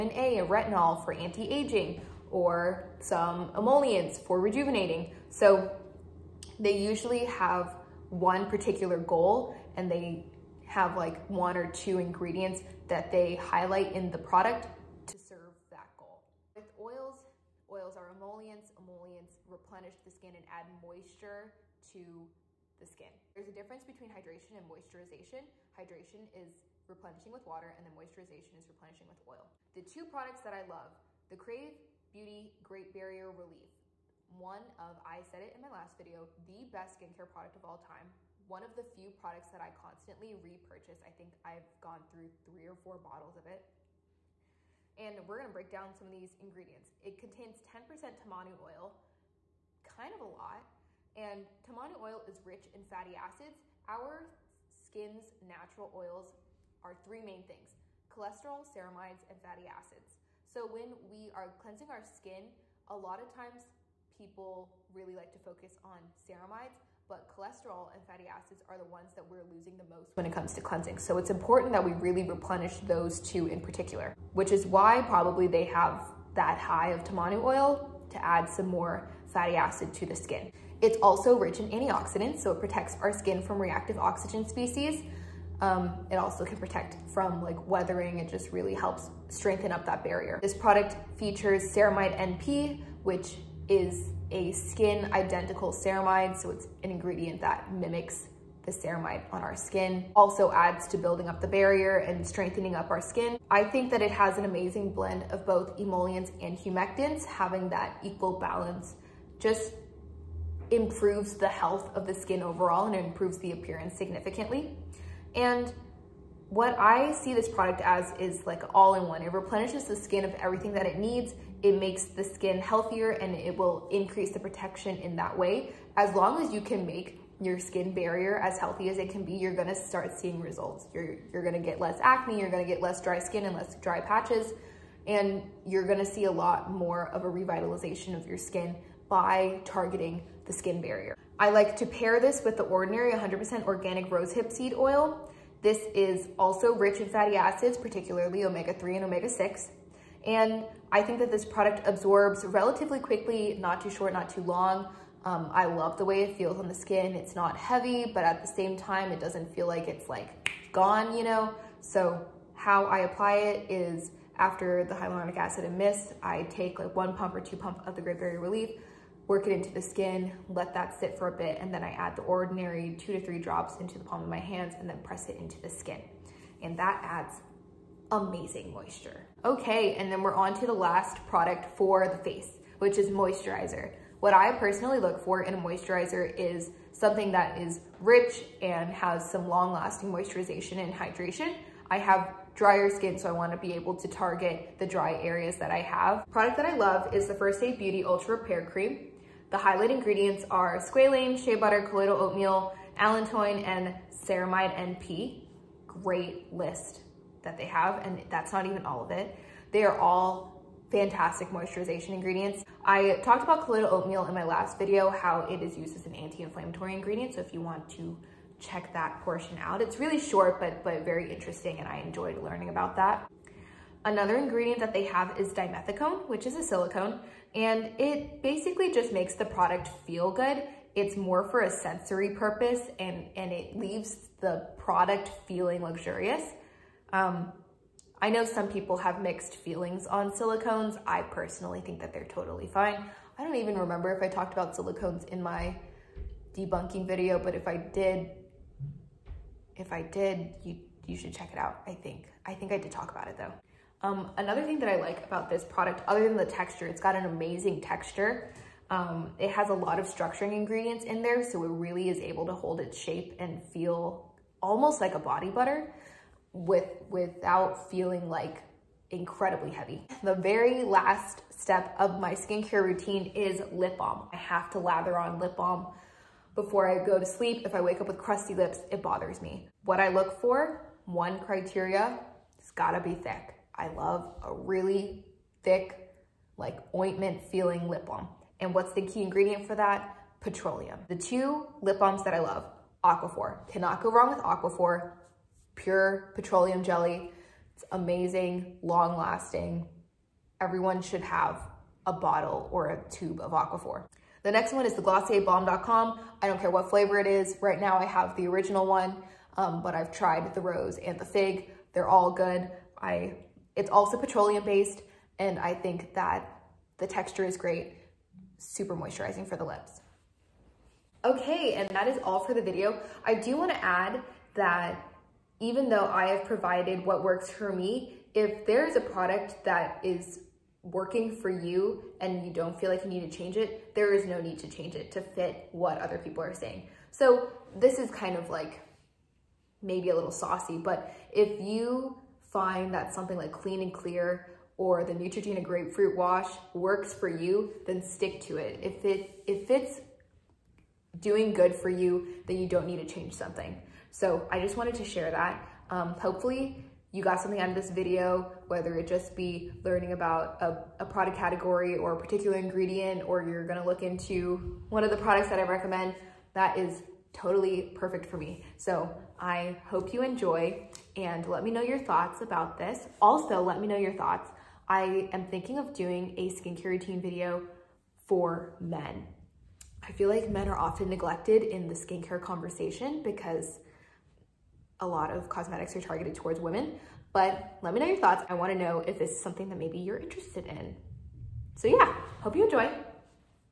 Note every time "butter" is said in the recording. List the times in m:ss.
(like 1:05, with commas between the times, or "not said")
3:21, 4:25.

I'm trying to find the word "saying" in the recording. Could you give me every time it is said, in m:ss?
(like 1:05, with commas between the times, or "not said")
5:36.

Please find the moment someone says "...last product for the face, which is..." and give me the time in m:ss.
3:00.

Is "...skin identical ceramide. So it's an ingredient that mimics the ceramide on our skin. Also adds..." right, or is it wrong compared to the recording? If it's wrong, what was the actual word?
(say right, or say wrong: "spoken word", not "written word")
right.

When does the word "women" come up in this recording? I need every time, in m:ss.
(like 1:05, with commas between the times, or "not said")
6:26.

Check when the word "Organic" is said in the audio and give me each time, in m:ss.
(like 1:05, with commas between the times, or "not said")
2:23.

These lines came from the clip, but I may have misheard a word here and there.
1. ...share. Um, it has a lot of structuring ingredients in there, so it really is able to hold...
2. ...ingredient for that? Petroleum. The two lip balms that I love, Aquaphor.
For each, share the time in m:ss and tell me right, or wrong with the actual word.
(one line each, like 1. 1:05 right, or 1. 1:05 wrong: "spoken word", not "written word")
1. 4:17 wrong: "texture", not "share"
2. 4:49 right.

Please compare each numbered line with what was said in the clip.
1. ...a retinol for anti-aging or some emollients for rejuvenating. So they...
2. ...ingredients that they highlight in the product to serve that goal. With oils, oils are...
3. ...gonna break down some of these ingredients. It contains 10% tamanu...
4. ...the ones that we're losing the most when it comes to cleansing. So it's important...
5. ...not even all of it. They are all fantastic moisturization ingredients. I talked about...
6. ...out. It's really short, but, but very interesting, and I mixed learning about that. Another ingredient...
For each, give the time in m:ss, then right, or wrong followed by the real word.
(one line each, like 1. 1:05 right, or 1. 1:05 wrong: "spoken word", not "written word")
1. 0:00 right
2. 0:11 right
3. 0:45 right
4. 1:08 right
5. 3:28 right
6. 3:39 wrong: "enjoyed", not "mixed".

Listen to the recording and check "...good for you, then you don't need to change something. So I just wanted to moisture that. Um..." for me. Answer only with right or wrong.
wrong.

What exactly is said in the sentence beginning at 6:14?
I am thinking of doing a skincare routine video for men.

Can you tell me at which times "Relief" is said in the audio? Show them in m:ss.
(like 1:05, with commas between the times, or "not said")
0:33, 2:48.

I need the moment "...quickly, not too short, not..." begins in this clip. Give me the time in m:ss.
2:32.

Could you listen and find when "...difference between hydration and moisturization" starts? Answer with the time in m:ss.
0:23.